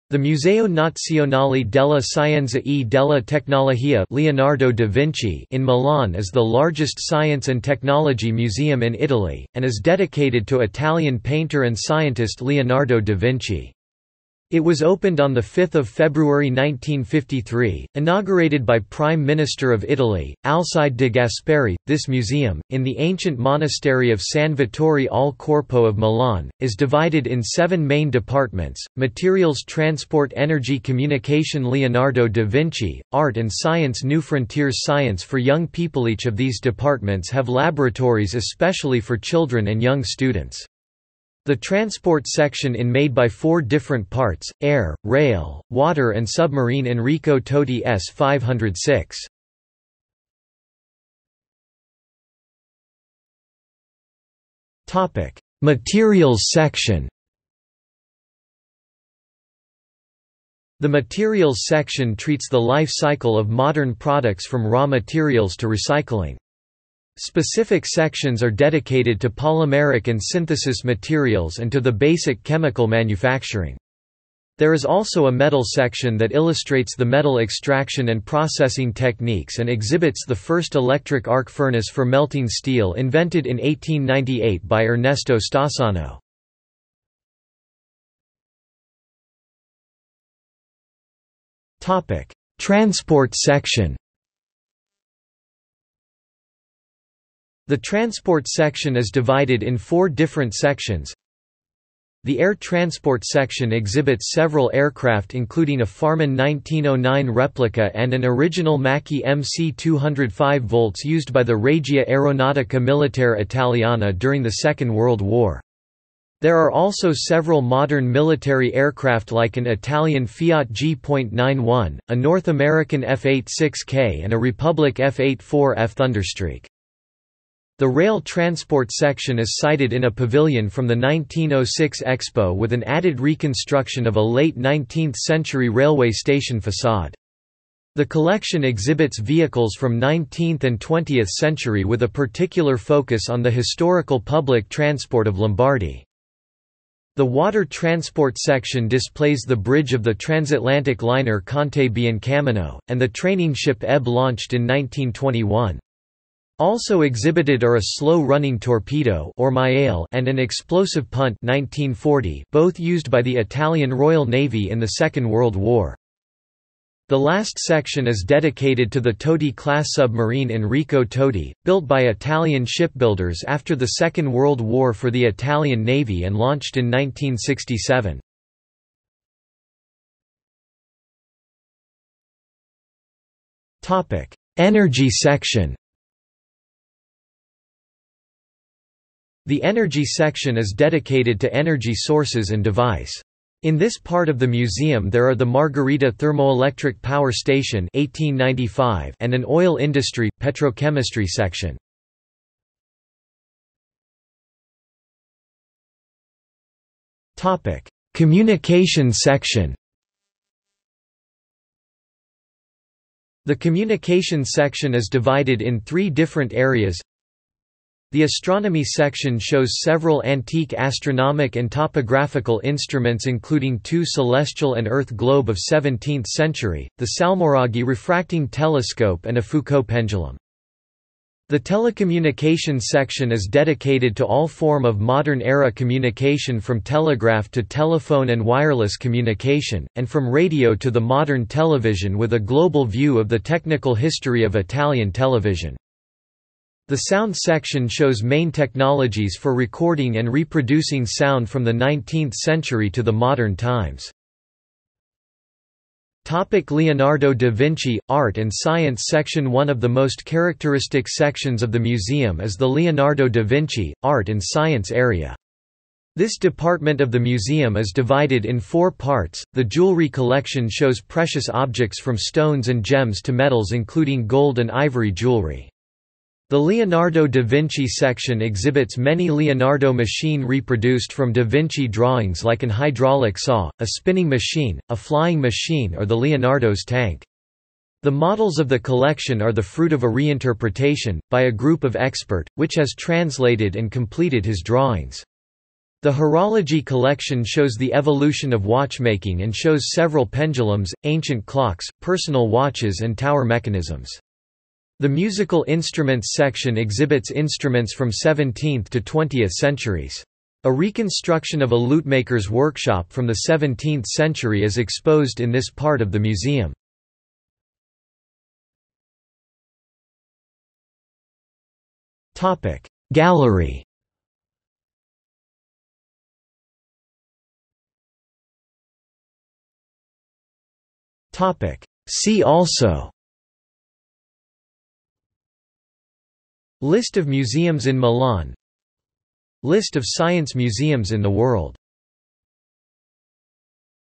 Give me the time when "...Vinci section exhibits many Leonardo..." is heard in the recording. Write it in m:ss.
4:37.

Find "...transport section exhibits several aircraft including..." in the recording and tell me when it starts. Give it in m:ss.
1:42.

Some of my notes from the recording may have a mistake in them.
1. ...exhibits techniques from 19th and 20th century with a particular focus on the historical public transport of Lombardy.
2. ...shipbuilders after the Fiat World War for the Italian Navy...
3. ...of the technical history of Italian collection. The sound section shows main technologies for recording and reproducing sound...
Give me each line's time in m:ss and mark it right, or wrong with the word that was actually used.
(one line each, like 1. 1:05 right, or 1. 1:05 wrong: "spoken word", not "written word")
1. 2:18 wrong: "vehicles", not "techniques"
2. 2:52 wrong: "Second", not "Fiat"
3. 4:03 wrong: "television", not "collection".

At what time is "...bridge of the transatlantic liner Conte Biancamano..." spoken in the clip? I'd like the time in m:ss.
2:29.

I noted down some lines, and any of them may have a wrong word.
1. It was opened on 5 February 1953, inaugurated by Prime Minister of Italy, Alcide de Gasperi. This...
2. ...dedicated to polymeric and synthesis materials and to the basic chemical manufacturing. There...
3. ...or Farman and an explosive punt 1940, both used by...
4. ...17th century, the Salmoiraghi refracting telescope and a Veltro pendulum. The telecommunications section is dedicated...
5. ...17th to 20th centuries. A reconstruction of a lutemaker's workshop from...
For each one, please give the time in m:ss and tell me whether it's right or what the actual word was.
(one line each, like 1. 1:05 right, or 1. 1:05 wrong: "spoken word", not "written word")
1. 0:14 right
2. 1:08 right
3. 2:39 wrong: "Maiale", not "Farman"
4. 3:45 wrong: "Foucault", not "Veltro"
5. 5:08 right.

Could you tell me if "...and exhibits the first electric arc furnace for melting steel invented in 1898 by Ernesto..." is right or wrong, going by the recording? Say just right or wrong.
right.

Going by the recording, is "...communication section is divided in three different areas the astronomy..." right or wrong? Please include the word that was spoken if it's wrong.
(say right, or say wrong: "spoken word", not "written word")
right.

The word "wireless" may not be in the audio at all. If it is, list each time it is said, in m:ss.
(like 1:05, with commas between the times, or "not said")
3:58.